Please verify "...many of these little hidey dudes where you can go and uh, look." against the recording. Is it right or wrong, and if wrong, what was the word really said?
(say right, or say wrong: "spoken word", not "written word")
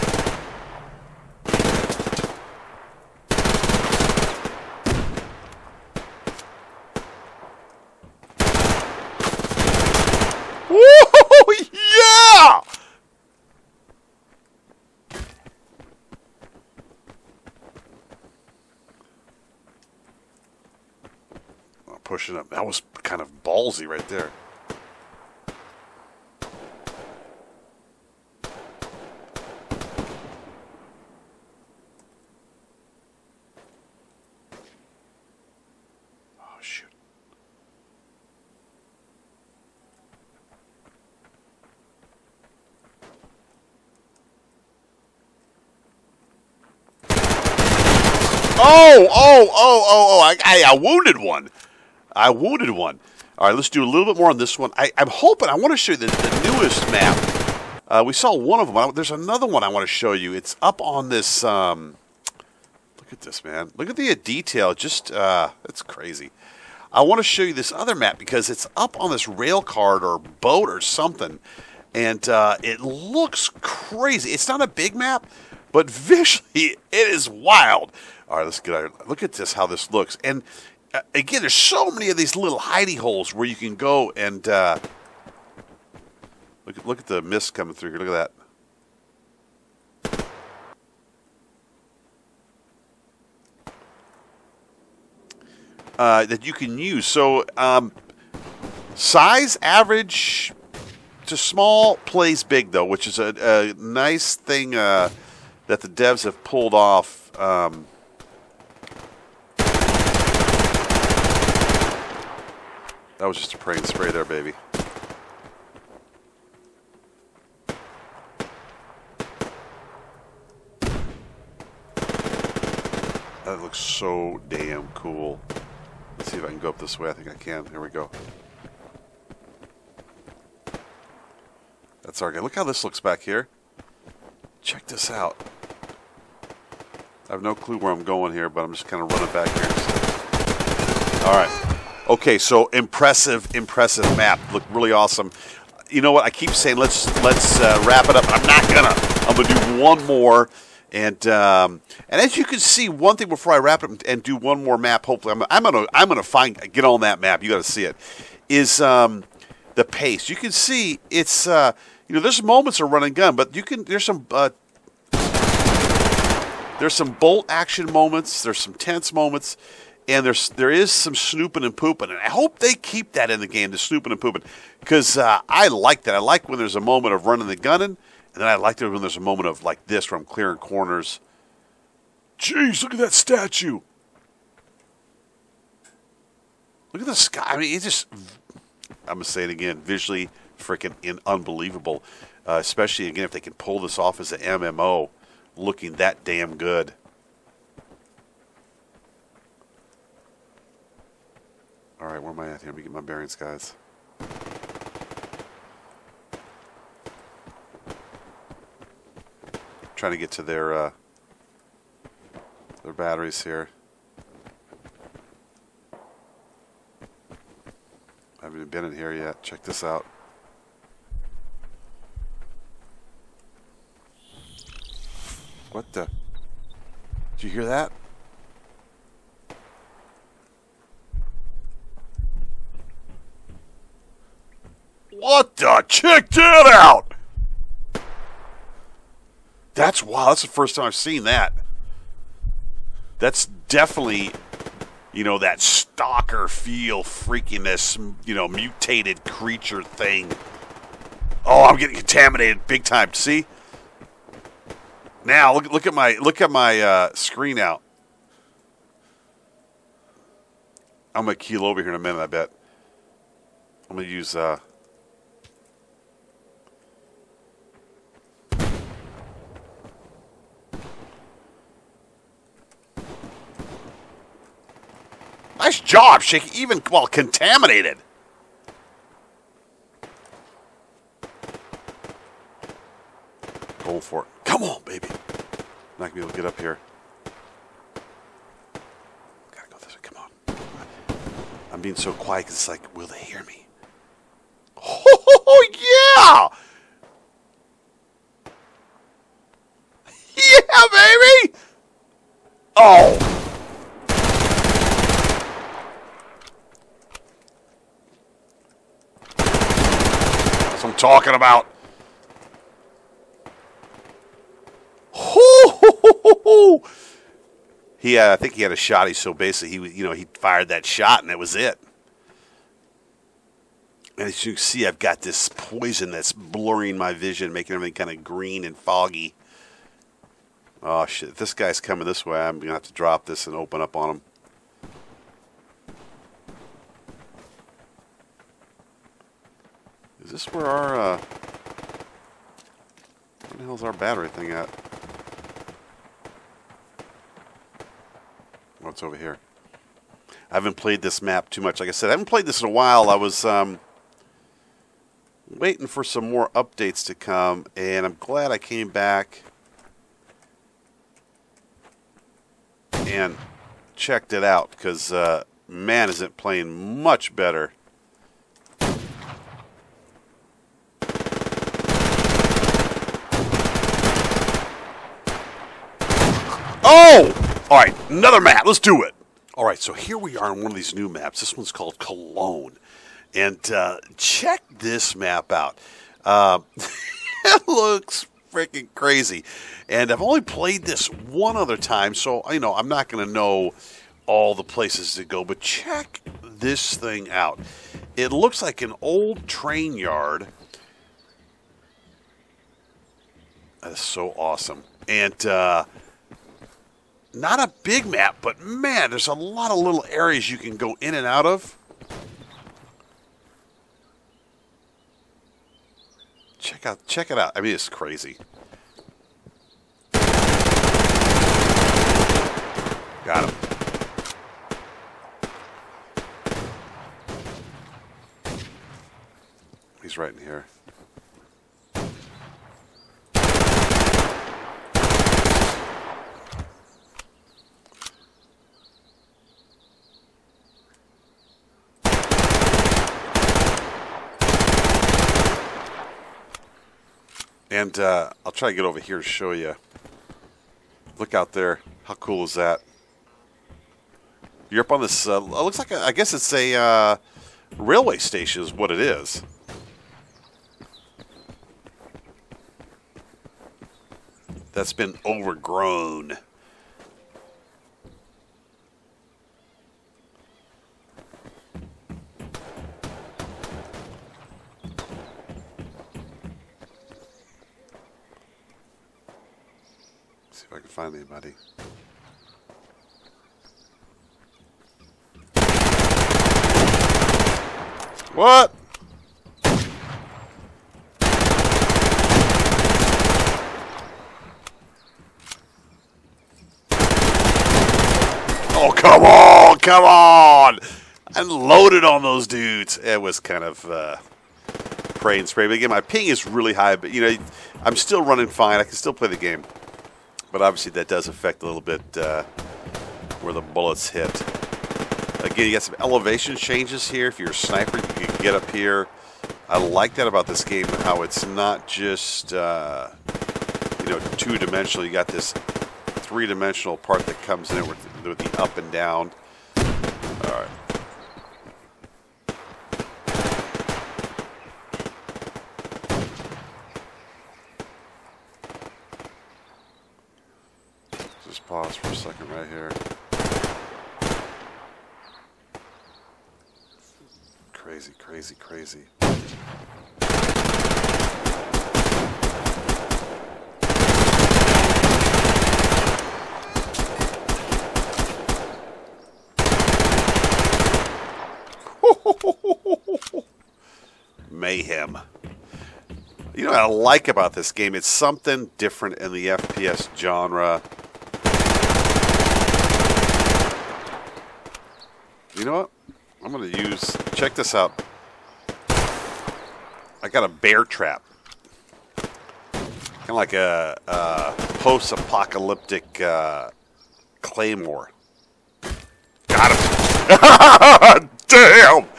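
wrong: "holes", not "dudes".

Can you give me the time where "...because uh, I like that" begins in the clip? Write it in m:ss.
2:54.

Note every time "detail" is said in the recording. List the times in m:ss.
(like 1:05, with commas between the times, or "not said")
1:04.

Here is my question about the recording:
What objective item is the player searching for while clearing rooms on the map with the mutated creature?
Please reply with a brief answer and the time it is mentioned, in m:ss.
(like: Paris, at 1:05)
batteries, at 3:32.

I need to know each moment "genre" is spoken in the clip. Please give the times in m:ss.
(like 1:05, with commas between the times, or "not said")
9:30.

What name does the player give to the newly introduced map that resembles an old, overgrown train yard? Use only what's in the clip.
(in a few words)
Cologne.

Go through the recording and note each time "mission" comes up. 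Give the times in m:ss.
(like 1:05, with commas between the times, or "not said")
not said.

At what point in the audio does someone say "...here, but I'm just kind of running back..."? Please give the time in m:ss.
2:18.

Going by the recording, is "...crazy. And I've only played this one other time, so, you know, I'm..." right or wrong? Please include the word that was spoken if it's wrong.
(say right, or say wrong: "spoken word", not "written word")
right.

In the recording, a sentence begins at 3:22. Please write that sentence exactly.
All right, where am I at here?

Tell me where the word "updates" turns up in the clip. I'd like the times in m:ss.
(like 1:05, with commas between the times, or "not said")
5:56.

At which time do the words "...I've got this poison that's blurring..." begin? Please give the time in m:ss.
5:24.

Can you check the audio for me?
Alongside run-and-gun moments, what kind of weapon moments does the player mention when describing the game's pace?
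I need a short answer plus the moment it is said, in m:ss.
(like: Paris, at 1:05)
bolt action, at 2:47.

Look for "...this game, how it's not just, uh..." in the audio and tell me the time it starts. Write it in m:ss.
8:40.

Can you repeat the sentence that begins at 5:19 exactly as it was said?
He so basically he you know he fired that shot and that was it.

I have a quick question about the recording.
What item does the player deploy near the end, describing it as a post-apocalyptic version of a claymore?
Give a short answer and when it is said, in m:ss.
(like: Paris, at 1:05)
bear trap, at 9:40.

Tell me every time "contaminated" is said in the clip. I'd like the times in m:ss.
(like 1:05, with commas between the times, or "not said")
4:11, 4:37.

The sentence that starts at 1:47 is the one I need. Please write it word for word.
Um, That was just a praying spray there, baby.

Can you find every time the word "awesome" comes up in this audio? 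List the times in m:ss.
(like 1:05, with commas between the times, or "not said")
2:24, 6:44.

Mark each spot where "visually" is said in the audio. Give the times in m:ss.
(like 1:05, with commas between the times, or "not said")
1:15, 3:09.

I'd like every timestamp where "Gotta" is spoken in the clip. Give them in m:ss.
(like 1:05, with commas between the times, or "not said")
4:49.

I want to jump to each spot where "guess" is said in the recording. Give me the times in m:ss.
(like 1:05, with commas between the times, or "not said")
7:36.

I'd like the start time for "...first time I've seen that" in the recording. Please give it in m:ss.
4:00.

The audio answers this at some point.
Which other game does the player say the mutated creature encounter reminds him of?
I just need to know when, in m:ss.
4:05.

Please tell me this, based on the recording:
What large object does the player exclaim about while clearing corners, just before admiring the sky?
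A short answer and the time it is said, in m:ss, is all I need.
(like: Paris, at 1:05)
statue, at 3:03.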